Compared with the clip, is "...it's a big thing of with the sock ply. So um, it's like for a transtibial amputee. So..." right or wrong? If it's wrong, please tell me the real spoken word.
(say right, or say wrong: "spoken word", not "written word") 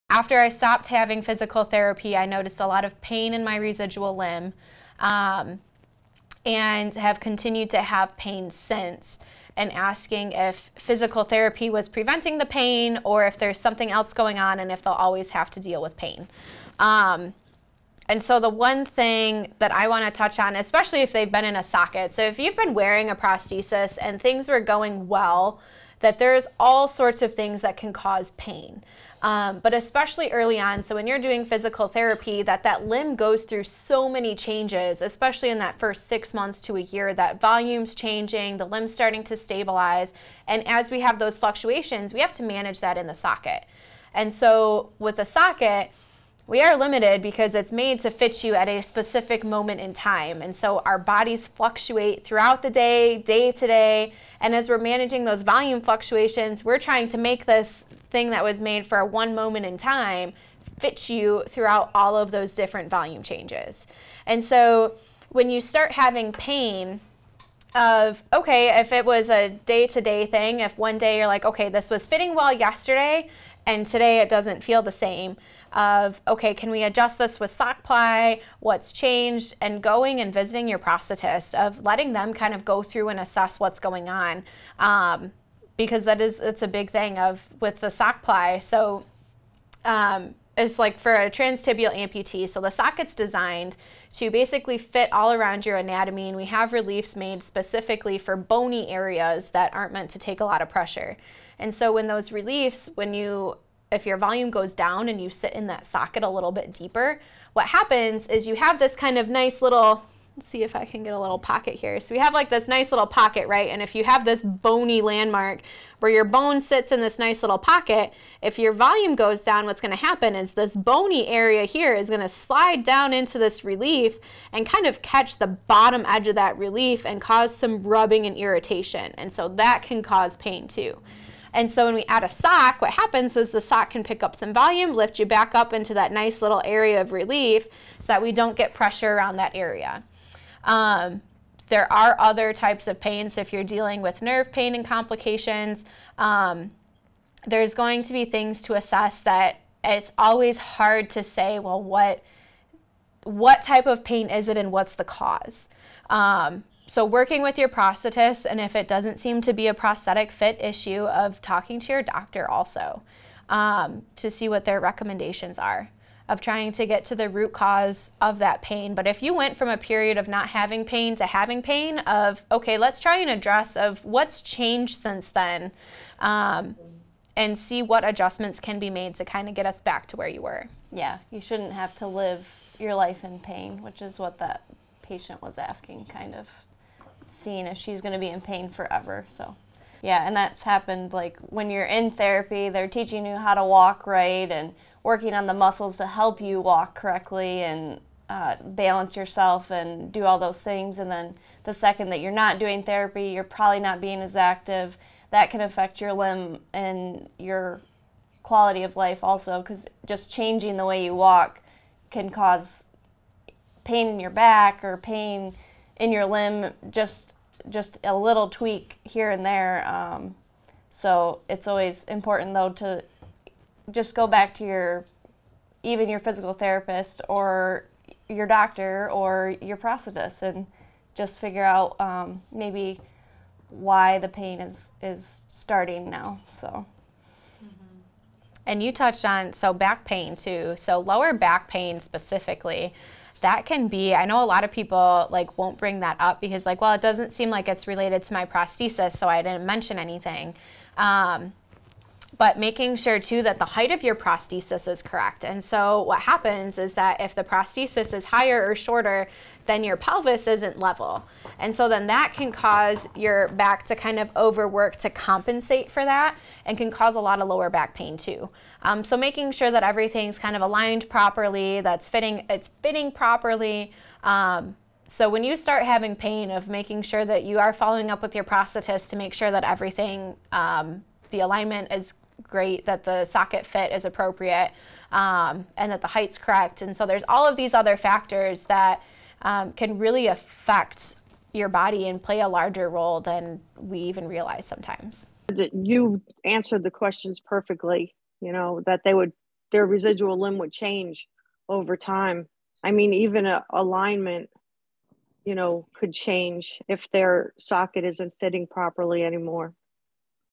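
right.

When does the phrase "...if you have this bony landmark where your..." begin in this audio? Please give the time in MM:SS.
01:53.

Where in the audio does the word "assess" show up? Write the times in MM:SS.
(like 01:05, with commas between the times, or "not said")
01:23, 02:28.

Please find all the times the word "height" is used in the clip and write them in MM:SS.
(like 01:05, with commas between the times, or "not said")
04:13, 04:46.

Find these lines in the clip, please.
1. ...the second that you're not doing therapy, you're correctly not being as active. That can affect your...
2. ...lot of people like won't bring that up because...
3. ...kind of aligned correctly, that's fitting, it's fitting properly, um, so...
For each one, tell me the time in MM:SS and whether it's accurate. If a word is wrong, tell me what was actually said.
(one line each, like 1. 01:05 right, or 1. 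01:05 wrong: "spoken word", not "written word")
1. 03:21 wrong: "probably", not "correctly"
2. 04:04 right
3. 04:30 wrong: "properly", not "correctly".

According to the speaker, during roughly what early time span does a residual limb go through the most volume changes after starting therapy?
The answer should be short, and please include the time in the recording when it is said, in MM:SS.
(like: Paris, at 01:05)
6 months to a year, at 00:36.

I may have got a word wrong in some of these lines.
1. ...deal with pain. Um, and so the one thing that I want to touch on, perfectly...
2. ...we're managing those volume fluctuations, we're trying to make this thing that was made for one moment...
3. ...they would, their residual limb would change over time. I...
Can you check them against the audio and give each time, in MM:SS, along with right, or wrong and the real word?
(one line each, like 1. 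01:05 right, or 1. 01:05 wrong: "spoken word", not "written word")
1. 00:15 wrong: "especially", not "perfectly"
2. 00:54 right
3. 04:59 right.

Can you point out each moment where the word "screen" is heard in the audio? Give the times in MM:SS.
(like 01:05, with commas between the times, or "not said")
not said.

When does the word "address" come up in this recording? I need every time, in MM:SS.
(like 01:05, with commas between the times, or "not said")
02:53.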